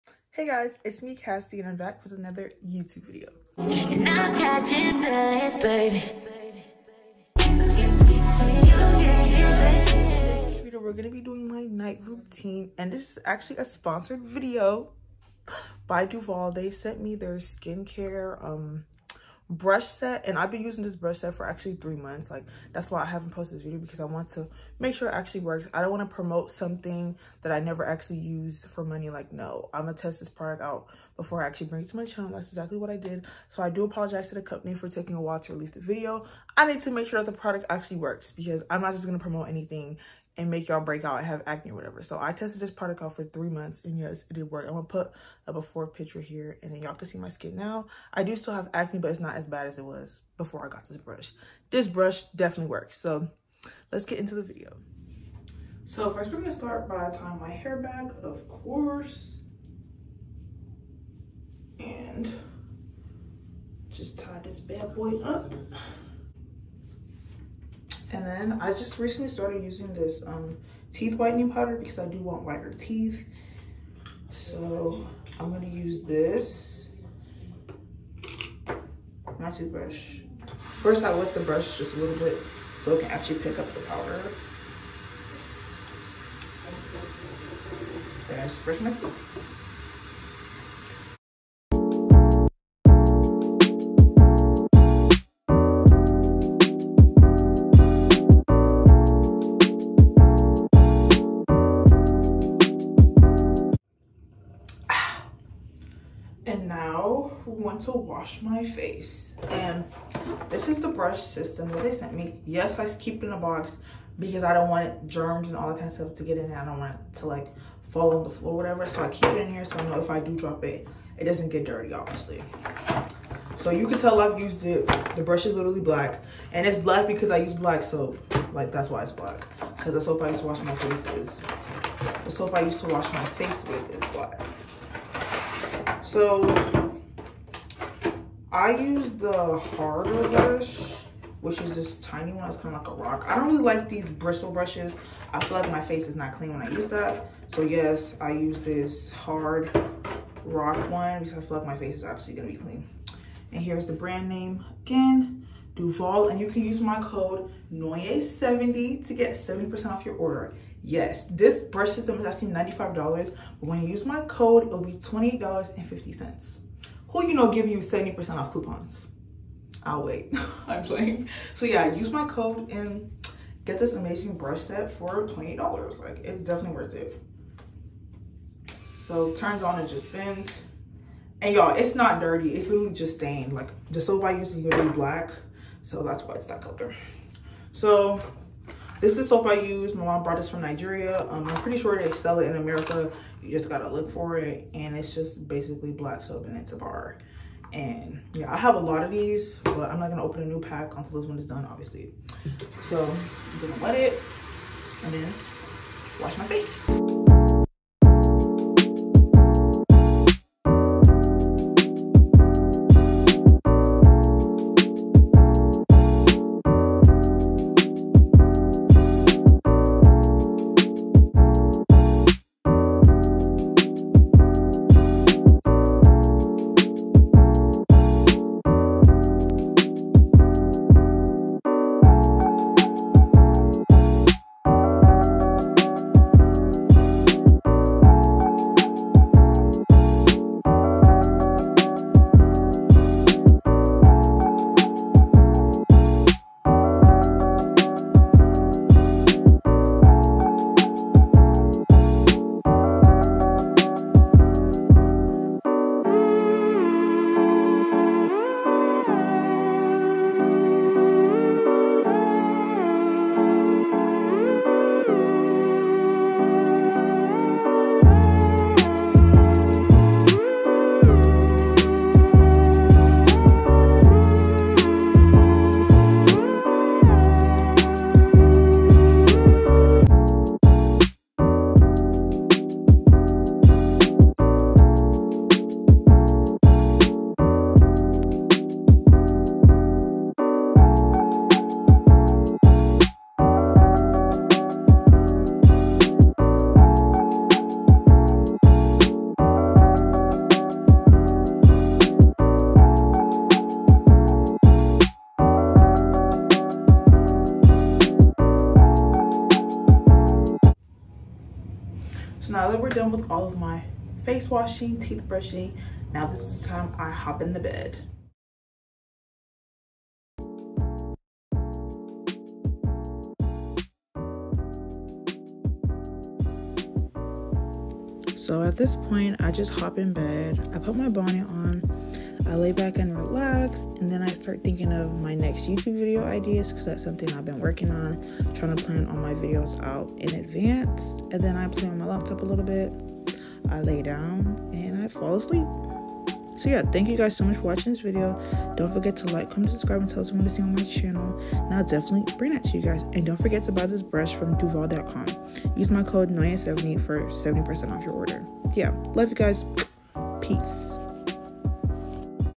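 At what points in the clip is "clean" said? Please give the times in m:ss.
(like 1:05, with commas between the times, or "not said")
2:26, 2:32.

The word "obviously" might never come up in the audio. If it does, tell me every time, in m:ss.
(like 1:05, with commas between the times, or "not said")
2:01, 3:21.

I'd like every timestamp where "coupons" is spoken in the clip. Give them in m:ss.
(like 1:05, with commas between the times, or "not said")
2:48.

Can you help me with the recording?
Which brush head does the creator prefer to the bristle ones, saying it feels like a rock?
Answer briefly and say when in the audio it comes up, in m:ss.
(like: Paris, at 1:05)
the harder brush, at 2:19.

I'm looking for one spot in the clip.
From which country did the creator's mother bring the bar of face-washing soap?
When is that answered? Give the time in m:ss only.
3:10.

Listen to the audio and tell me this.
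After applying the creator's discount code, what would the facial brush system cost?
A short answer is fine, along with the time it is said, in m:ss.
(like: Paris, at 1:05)
$28.50, at 2:44.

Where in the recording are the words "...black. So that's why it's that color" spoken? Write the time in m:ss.
3:04.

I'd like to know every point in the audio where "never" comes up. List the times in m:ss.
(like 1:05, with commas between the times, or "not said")
0:27.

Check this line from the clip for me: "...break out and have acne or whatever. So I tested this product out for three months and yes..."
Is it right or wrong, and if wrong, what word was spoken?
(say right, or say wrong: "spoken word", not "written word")
right.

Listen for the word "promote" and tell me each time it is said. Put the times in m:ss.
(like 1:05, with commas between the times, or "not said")
0:26, 0:39.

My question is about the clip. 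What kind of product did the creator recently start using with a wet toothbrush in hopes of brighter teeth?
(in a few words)
teeth whitening powder.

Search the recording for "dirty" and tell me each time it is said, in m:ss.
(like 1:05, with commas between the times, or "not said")
2:01, 3:02.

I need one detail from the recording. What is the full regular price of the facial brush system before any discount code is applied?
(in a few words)
$95.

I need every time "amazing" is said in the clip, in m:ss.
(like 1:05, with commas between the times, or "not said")
2:53.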